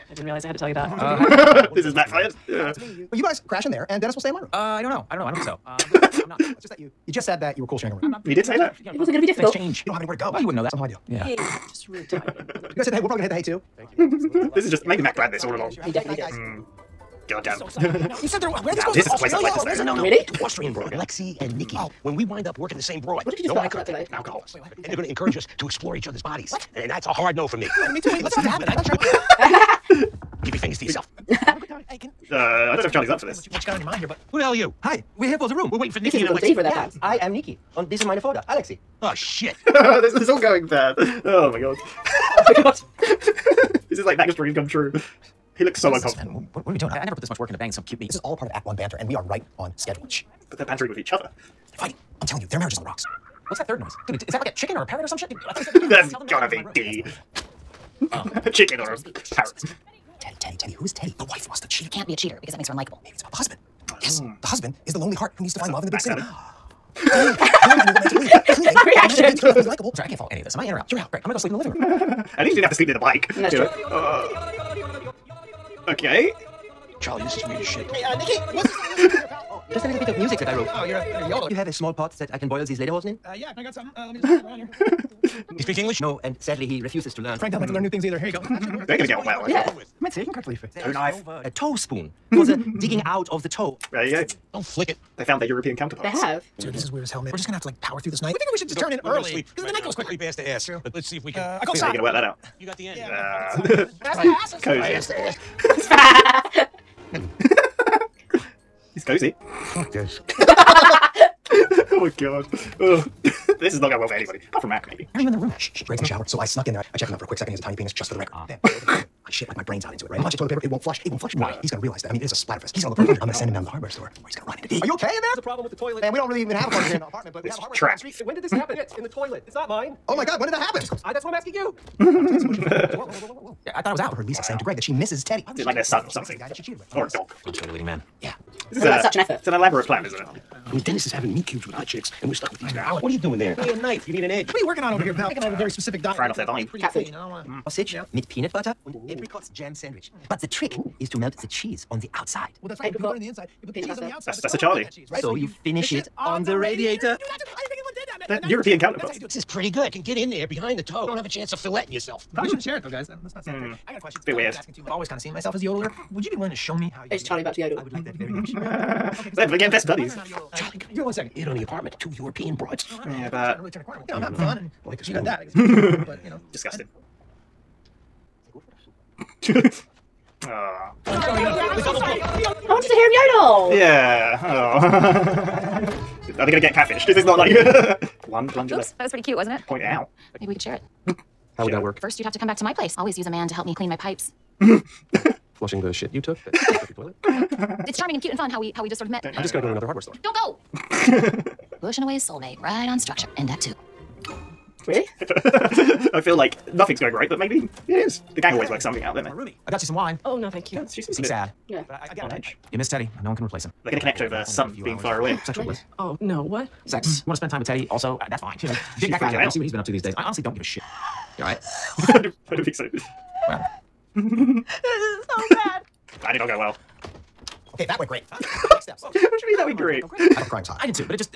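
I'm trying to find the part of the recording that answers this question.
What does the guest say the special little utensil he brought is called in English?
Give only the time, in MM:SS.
01:31.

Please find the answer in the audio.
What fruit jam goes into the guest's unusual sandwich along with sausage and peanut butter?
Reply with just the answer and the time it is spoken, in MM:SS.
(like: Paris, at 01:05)
Apricot, at 02:29.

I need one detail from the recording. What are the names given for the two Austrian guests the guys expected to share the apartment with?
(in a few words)
Lexi and Nikki.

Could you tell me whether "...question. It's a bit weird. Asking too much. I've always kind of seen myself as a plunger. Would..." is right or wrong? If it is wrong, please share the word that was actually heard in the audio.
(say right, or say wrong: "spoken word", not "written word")
wrong: "yodeler", not "plunger".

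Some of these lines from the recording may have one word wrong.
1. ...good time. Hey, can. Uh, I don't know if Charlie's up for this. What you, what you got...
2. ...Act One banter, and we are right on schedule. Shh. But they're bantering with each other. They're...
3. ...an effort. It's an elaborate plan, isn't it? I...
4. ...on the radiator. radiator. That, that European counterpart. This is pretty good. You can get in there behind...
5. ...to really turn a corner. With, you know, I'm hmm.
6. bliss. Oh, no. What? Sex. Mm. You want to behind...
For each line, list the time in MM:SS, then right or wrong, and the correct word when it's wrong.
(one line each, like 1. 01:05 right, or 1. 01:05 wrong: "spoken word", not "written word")
1. 00:31 right
2. 00:48 right
3. 02:19 right
4. 02:36 right
5. 02:53 right
6. 03:35 wrong: "spend", not "behind".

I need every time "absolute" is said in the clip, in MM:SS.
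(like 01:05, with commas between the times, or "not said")
not said.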